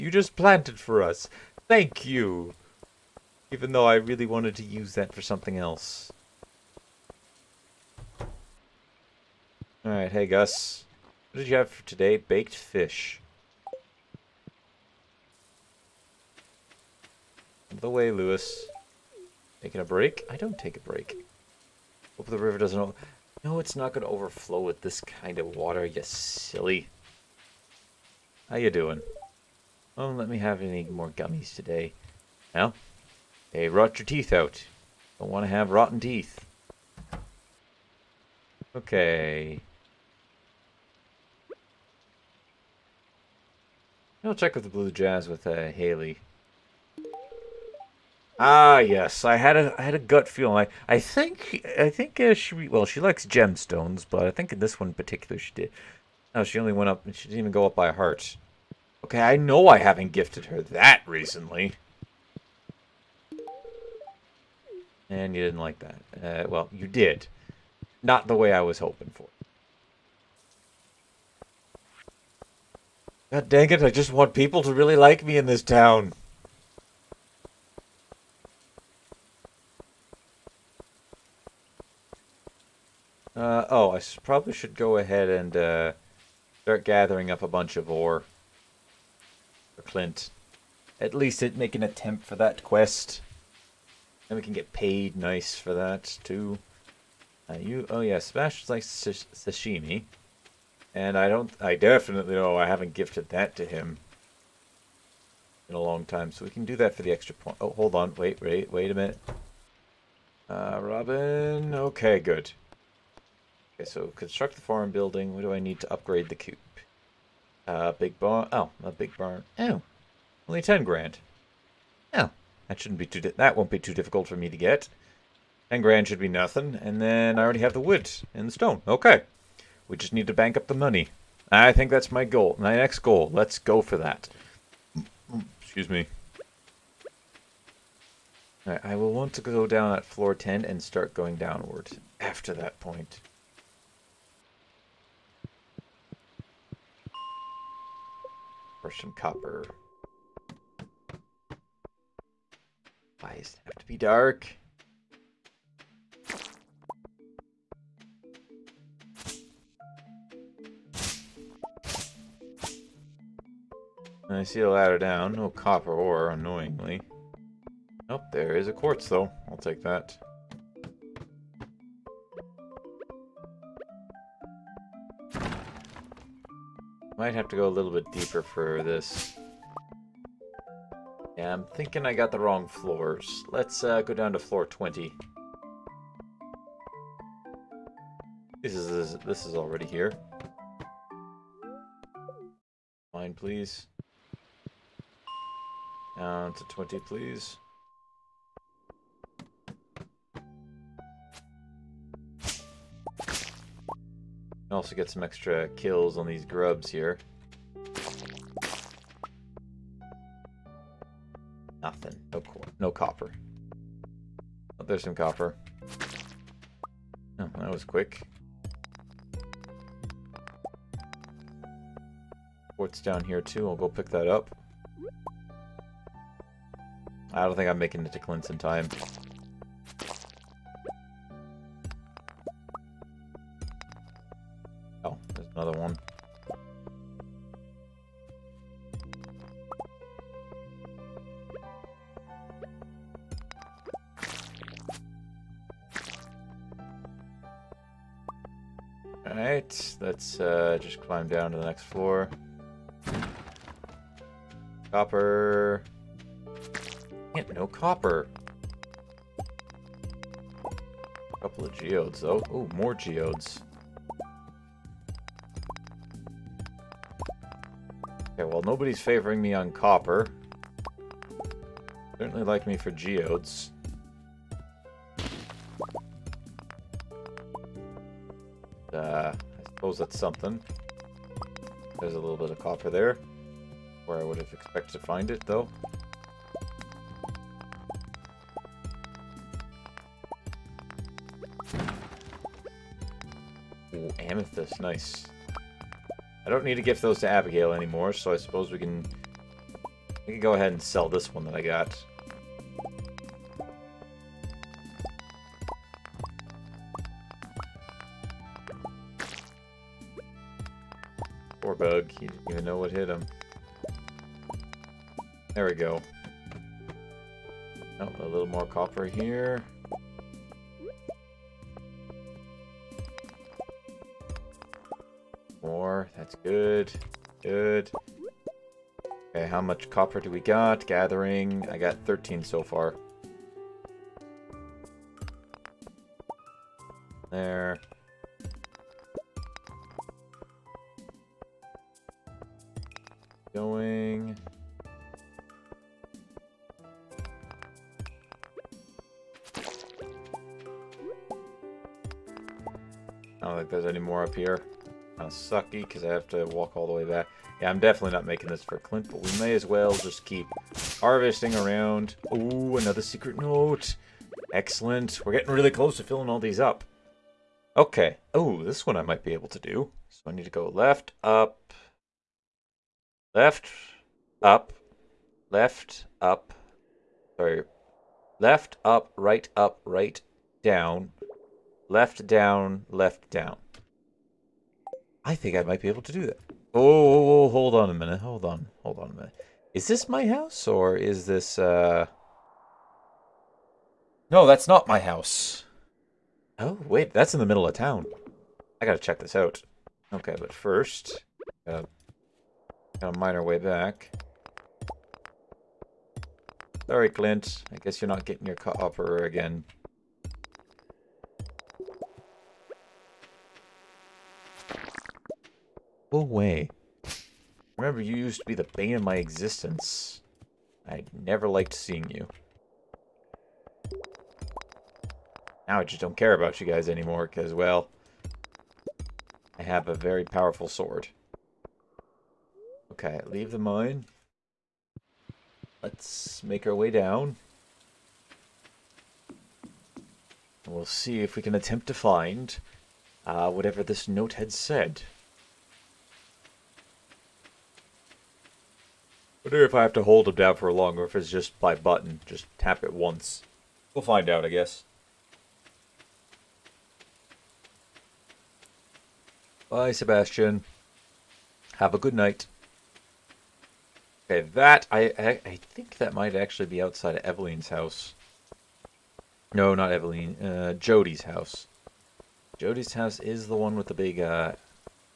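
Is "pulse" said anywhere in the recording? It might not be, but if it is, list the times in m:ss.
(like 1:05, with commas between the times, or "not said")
not said.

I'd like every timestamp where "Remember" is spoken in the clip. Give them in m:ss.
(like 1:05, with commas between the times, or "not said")
6:57.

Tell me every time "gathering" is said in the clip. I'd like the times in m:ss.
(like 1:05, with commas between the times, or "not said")
1:26, 5:30.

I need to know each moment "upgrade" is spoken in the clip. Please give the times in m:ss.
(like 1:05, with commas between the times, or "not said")
1:55.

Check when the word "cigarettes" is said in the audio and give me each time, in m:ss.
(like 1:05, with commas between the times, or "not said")
not said.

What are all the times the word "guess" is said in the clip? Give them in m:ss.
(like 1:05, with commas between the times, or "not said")
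6:47, 7:34.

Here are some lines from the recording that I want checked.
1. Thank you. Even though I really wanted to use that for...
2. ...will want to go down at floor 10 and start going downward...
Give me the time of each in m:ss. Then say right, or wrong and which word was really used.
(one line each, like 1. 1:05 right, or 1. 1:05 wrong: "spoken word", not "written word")
1. 0:01 right
2. 2:18 right.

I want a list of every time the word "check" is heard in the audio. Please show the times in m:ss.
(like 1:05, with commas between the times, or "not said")
0:44, 6:38.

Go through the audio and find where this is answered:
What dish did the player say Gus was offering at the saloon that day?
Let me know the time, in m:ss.
0:12.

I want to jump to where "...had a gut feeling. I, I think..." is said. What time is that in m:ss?
0:49.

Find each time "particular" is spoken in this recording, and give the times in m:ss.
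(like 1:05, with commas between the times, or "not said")
0:54.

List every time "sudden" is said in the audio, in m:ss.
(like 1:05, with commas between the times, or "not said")
not said.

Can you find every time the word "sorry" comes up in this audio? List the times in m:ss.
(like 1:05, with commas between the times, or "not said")
6:17, 6:46.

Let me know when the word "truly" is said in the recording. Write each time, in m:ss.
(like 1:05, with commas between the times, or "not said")
not said.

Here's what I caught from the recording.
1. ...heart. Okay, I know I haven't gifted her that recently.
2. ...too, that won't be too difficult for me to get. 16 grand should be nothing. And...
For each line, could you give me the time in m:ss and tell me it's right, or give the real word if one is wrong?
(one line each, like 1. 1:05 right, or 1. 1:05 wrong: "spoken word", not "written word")
1. 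0:57 right
2. 2:03 wrong: "10", not "16".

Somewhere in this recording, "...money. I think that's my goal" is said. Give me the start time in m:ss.
2:10.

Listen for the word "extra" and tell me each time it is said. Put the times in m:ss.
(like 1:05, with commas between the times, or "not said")
1:47, 3:25.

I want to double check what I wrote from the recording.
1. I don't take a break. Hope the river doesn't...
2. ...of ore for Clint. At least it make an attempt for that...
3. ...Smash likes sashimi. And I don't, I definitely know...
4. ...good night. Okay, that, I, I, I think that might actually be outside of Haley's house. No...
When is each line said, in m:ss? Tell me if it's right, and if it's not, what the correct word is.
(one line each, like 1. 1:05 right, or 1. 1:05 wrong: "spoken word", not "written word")
1. 0:20 right
2. 1:27 right
3. 1:38 right
4. 7:41 wrong: "Evelyn", not "Haley".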